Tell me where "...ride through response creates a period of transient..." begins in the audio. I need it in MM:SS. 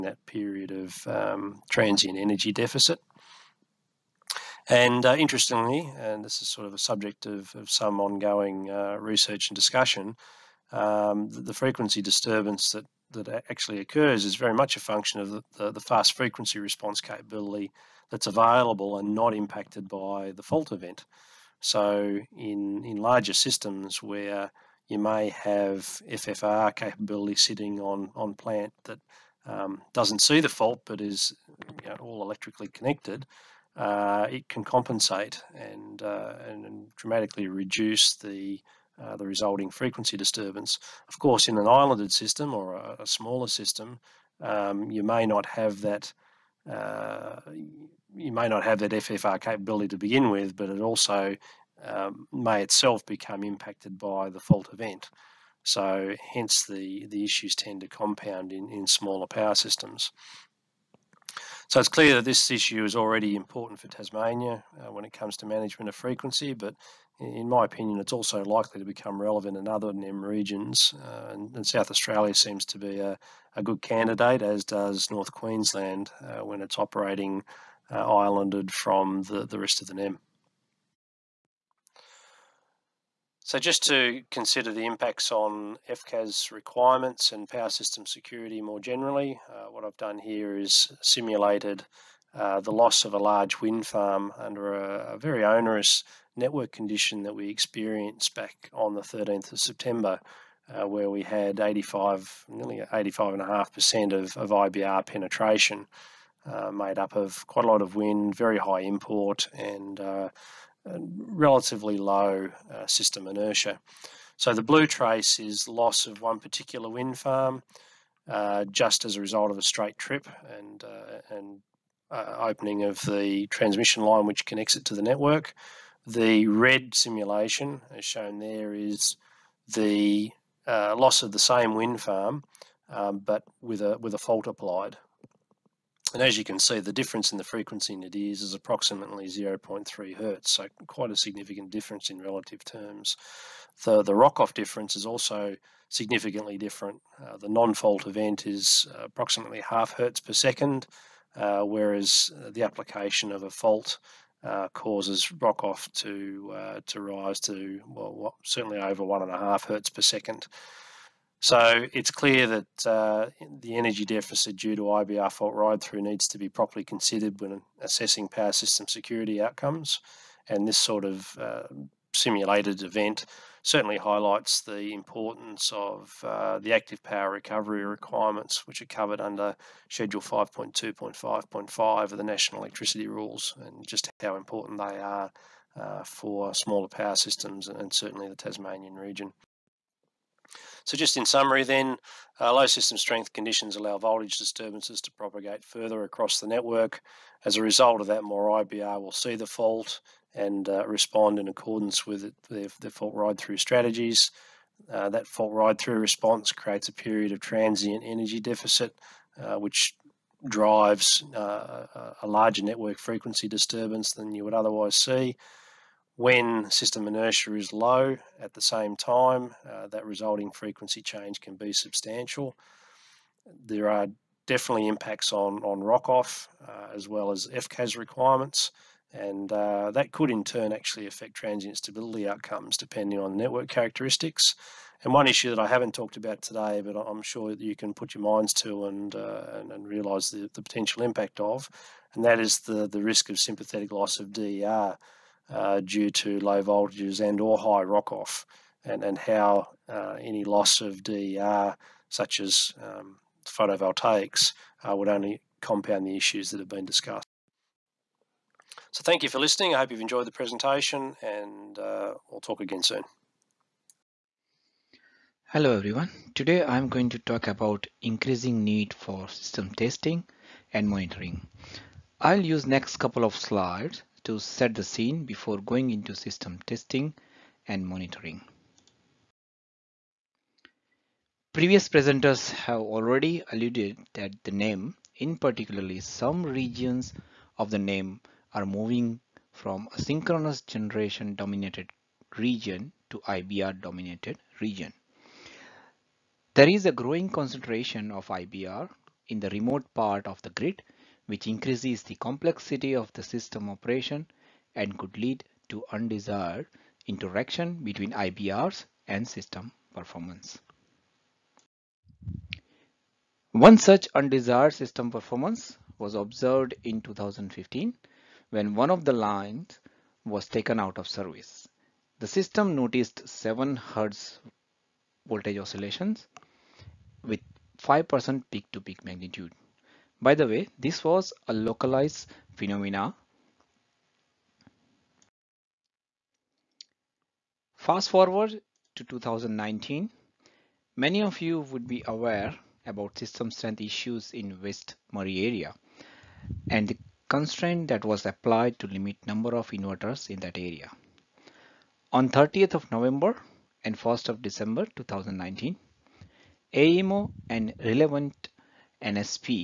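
03:25.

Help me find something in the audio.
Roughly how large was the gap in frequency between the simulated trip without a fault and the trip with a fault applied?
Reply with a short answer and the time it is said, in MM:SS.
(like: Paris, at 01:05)
0.3 Hz, at 02:19.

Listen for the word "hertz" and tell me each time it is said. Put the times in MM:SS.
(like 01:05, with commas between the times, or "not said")
02:20, 02:29, 02:39.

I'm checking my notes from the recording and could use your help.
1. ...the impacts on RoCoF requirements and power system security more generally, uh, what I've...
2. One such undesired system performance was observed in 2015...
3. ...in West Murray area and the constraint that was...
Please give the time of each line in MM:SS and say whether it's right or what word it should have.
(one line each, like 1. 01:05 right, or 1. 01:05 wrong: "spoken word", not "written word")
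1. 01:24 wrong: "FCAS", not "RoCoF"
2. 05:13 right
3. 05:44 right.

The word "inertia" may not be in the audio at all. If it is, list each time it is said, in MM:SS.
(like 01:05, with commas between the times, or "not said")
01:53, 03:37.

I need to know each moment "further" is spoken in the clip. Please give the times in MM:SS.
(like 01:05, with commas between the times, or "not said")
03:15.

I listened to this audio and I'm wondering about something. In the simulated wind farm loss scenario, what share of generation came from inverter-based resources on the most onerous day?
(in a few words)
85.5%.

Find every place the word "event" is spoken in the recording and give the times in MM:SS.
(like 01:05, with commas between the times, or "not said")
00:20, 00:54, 02:28, 02:52.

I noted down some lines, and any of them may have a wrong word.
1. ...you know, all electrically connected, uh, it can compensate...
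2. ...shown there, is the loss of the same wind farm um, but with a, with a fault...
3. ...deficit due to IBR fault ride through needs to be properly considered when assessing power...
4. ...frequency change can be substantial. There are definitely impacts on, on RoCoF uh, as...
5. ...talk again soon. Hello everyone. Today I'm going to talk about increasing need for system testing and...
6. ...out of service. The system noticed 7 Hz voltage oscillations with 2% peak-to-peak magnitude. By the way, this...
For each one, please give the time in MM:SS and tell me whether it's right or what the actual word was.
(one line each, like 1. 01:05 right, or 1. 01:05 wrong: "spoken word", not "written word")
1. 00:31 right
2. 02:08 right
3. 02:44 right
4. 03:40 right
5. 04:22 right
6. 05:20 wrong: "5", not "2".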